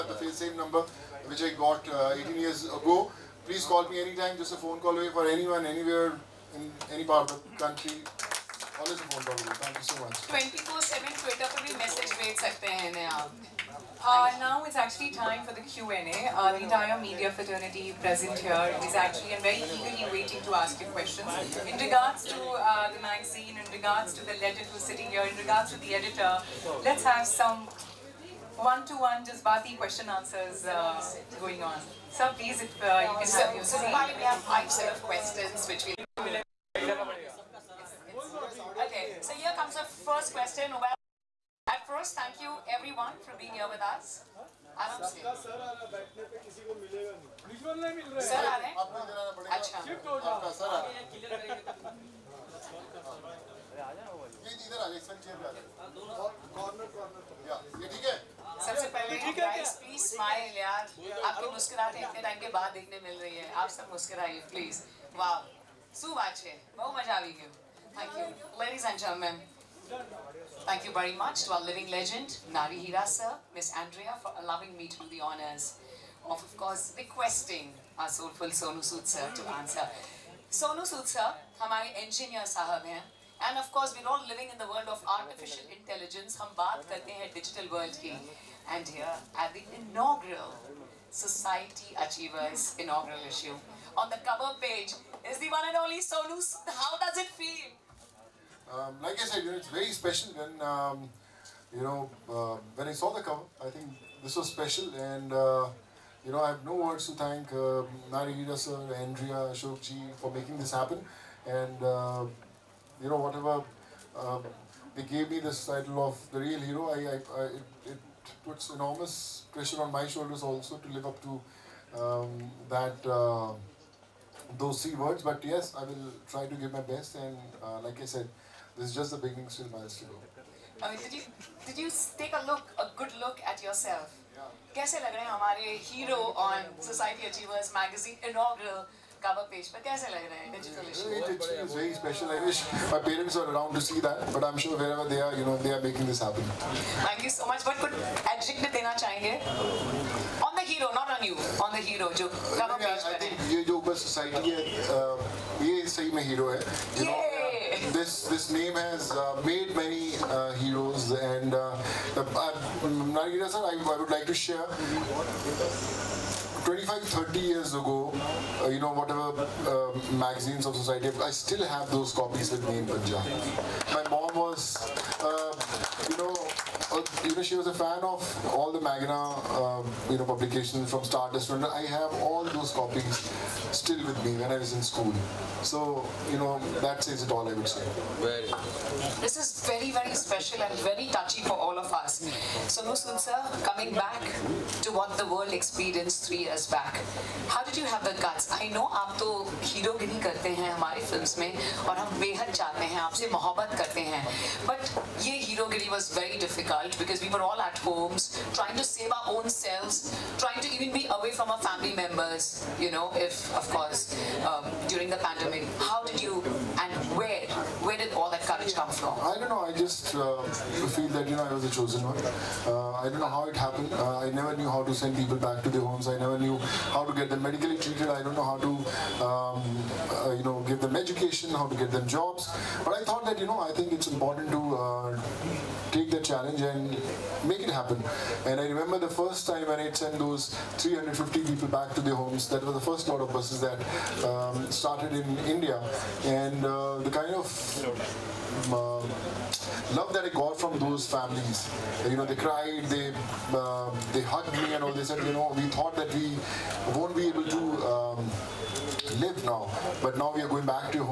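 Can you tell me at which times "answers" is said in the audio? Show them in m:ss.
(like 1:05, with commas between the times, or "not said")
0:30, 1:19.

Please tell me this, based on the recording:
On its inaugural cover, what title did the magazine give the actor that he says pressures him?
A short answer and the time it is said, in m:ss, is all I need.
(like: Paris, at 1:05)
The real hero, at 1:56.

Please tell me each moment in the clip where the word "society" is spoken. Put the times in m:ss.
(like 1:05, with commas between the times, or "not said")
1:31, 2:34, 2:50.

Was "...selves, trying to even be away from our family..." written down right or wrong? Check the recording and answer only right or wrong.
right.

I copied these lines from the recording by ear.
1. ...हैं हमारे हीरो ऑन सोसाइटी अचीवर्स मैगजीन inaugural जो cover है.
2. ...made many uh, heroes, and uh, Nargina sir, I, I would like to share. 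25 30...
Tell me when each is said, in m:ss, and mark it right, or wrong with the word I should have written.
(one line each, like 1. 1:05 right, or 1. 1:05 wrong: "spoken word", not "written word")
1. 2:15 right
2. 2:39 right.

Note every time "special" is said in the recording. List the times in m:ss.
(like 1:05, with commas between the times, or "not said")
1:39, 1:44, 3:10.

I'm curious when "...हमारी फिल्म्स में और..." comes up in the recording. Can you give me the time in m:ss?
3:20.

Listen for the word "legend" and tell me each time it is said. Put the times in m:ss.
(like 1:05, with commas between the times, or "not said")
0:24, 1:11.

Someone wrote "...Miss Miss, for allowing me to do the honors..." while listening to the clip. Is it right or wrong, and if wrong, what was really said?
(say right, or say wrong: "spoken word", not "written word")
wrong: "Andrea", not "Miss".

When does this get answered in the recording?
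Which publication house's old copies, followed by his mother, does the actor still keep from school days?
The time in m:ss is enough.
3:01.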